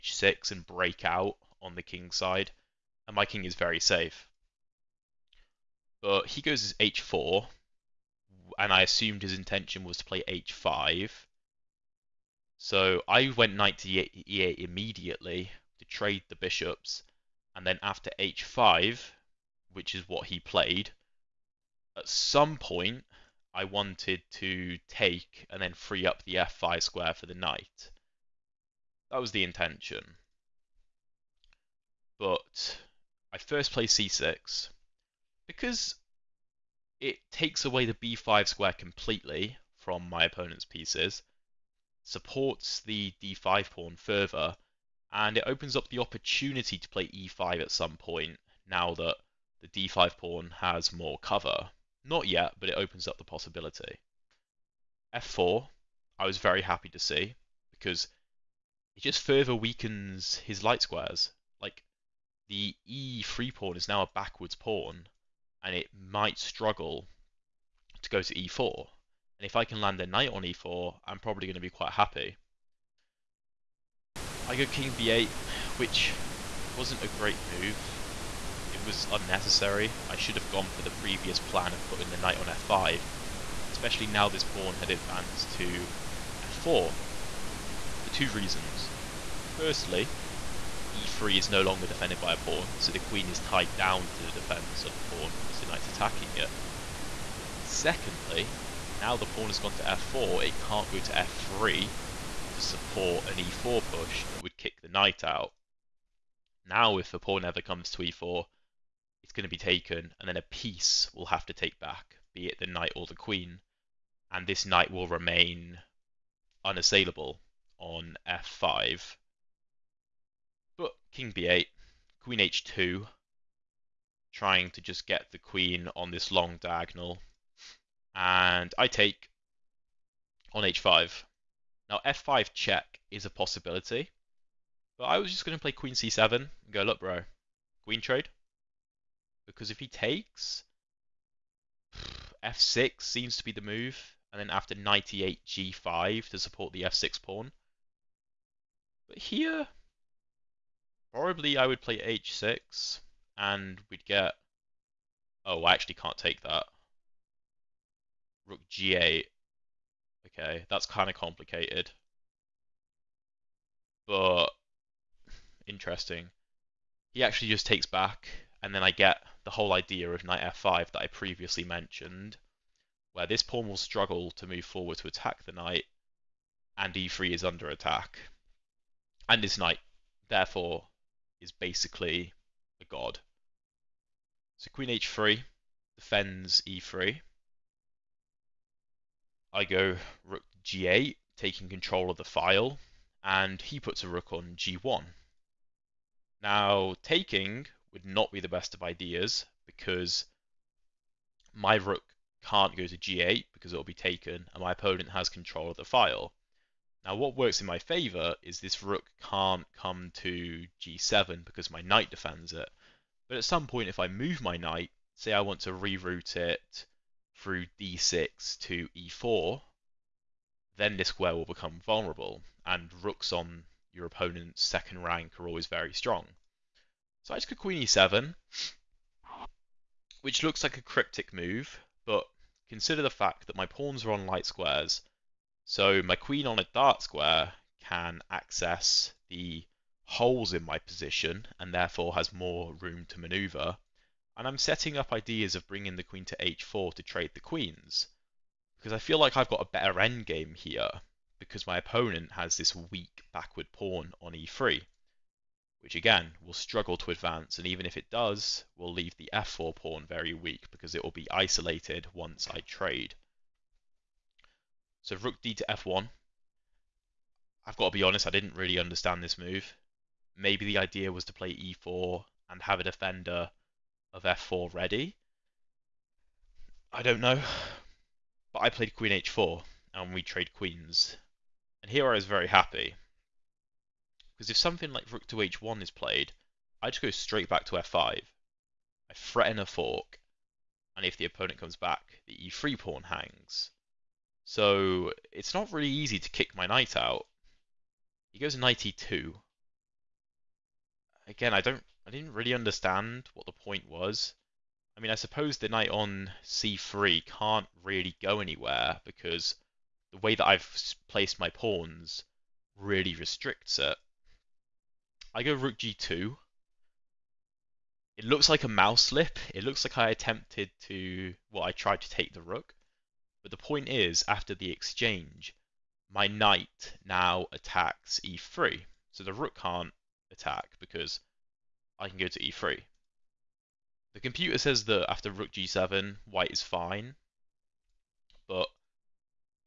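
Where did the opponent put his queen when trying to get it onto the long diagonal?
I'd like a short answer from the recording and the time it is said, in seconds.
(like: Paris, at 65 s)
h2, at 122 s.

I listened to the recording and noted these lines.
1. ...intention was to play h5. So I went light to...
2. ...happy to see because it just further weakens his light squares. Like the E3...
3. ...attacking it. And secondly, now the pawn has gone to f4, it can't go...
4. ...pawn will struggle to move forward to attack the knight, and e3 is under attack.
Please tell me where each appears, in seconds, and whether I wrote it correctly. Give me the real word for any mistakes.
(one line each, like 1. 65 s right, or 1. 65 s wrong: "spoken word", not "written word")
1. 9 s wrong: "knight", not "light"
2. 56 s right
3. 95 s right
4. 173 s right.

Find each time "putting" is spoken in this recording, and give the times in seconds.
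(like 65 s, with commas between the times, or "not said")
81 s.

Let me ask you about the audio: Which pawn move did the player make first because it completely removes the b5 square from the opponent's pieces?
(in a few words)
c6.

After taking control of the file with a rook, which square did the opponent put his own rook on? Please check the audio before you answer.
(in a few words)
g1.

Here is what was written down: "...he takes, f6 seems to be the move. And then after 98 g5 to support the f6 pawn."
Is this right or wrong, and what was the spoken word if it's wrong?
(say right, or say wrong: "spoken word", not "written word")
right.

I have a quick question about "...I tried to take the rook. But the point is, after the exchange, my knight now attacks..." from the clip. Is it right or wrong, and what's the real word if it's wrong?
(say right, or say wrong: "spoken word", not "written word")
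right.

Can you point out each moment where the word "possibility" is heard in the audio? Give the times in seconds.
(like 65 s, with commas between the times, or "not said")
53 s, 133 s.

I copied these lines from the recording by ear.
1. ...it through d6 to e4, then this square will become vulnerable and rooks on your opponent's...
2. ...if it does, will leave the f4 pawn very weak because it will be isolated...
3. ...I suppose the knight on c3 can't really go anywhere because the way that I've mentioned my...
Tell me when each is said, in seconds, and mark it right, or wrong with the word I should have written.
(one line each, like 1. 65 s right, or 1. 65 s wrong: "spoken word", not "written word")
1. 216 s right
2. 257 s right
3. 305 s wrong: "placed", not "mentioned".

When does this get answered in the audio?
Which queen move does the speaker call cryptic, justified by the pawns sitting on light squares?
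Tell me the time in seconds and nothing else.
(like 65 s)
227 s.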